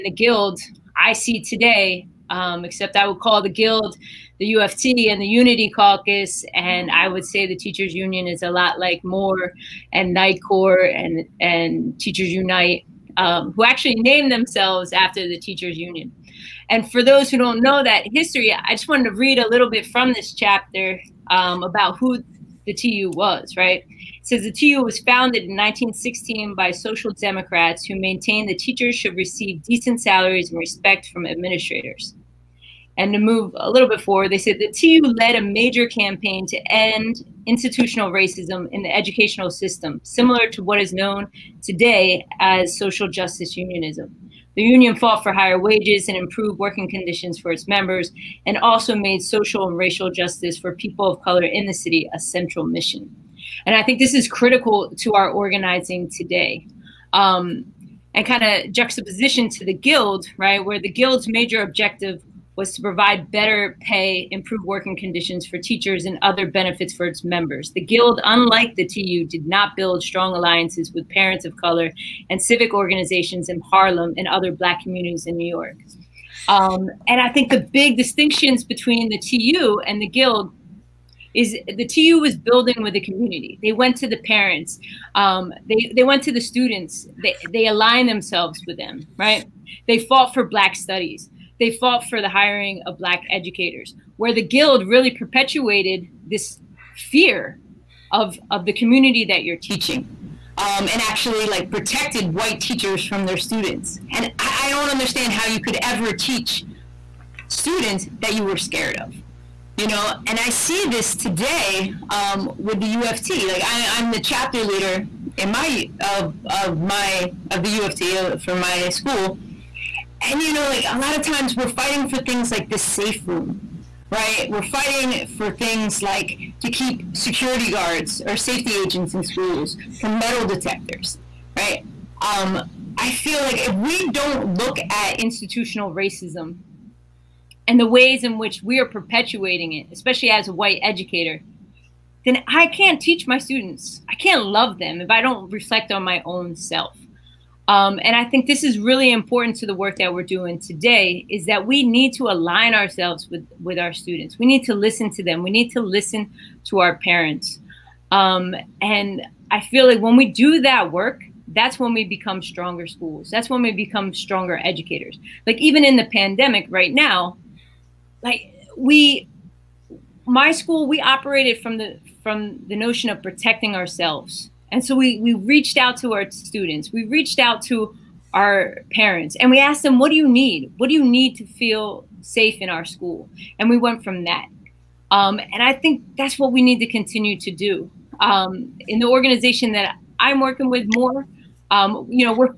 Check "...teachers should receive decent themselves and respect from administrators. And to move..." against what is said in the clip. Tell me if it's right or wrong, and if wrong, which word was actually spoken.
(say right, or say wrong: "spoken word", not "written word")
wrong: "salaries", not "themselves".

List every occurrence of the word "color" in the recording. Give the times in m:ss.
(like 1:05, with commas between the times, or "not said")
0:51, 1:11.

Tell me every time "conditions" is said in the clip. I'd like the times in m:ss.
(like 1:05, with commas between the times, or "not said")
0:46, 1:04.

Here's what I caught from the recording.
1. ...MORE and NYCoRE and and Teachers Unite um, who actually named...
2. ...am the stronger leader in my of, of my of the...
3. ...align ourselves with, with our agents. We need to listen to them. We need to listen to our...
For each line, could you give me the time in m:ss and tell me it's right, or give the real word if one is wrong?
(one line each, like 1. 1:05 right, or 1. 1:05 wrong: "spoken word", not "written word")
1. 0:09 right
2. 1:53 wrong: "chapter", not "stronger"
3. 2:32 wrong: "students", not "agents".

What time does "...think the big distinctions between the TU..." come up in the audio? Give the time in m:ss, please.
1:17.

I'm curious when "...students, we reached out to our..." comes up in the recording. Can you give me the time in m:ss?
2:56.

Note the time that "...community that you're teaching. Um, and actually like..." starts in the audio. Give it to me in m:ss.
1:38.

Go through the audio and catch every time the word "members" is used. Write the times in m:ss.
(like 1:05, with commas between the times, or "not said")
0:47, 1:07.